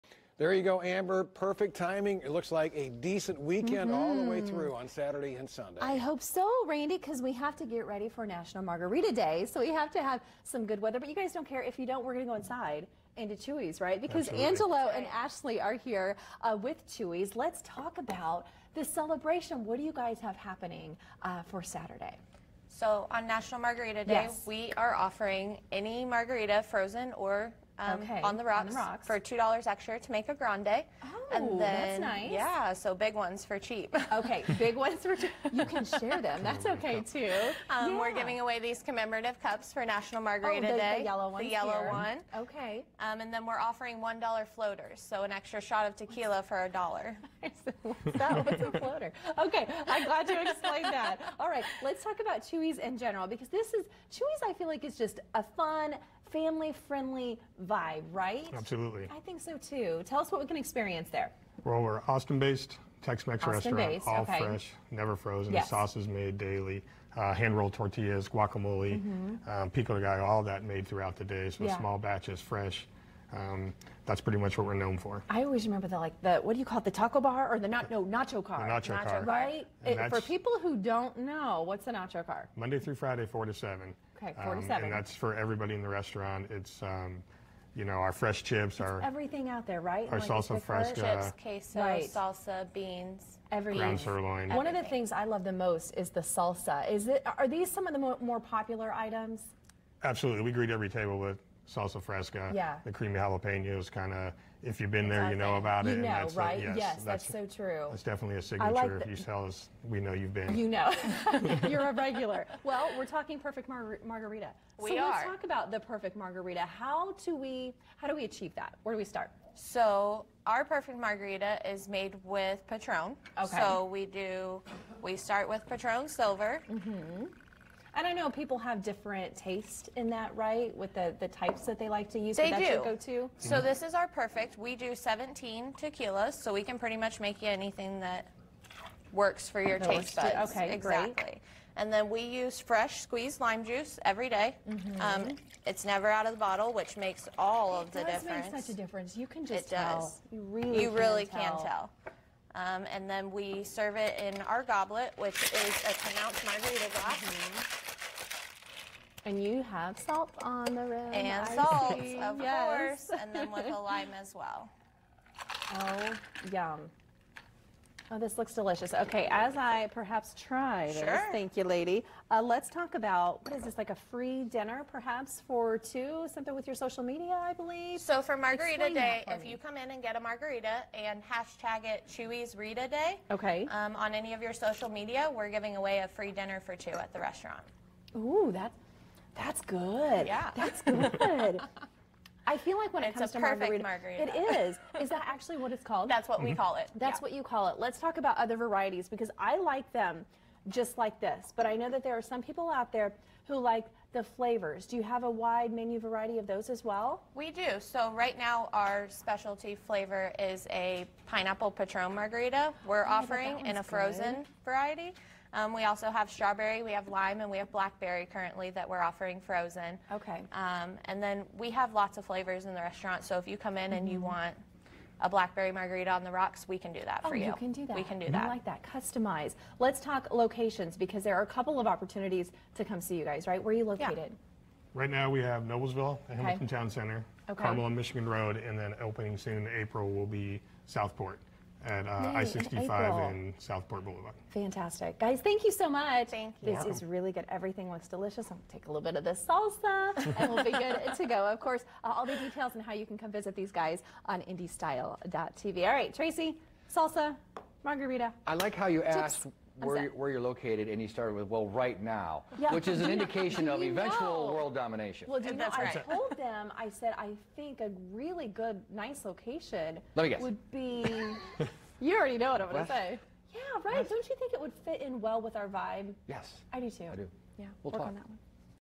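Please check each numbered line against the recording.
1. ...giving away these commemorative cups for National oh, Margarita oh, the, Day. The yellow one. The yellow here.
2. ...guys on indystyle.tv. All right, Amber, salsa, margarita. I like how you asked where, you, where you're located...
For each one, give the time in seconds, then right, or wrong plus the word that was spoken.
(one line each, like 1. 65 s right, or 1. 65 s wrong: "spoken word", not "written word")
1. 38 s right
2. 253 s wrong: "Tracy", not "Amber".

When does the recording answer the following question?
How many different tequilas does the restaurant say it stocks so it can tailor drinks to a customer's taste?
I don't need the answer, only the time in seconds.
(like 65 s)
134 s.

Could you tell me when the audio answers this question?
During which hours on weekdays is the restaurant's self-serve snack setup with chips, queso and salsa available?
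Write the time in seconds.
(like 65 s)
83 s.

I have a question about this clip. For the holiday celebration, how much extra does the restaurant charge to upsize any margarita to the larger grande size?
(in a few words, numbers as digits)
$2.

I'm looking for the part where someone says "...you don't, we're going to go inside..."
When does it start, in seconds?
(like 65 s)
11 s.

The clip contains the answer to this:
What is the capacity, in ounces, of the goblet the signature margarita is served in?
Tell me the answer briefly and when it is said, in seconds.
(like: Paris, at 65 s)
10 ounces, at 155 s.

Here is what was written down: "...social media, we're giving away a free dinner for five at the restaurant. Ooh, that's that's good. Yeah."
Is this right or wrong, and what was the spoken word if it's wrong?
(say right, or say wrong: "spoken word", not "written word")
wrong: "two", not "five".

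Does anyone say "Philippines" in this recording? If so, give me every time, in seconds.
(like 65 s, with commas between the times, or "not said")
not said.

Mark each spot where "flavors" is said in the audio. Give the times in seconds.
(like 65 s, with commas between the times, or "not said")
204 s, 209 s, 222 s.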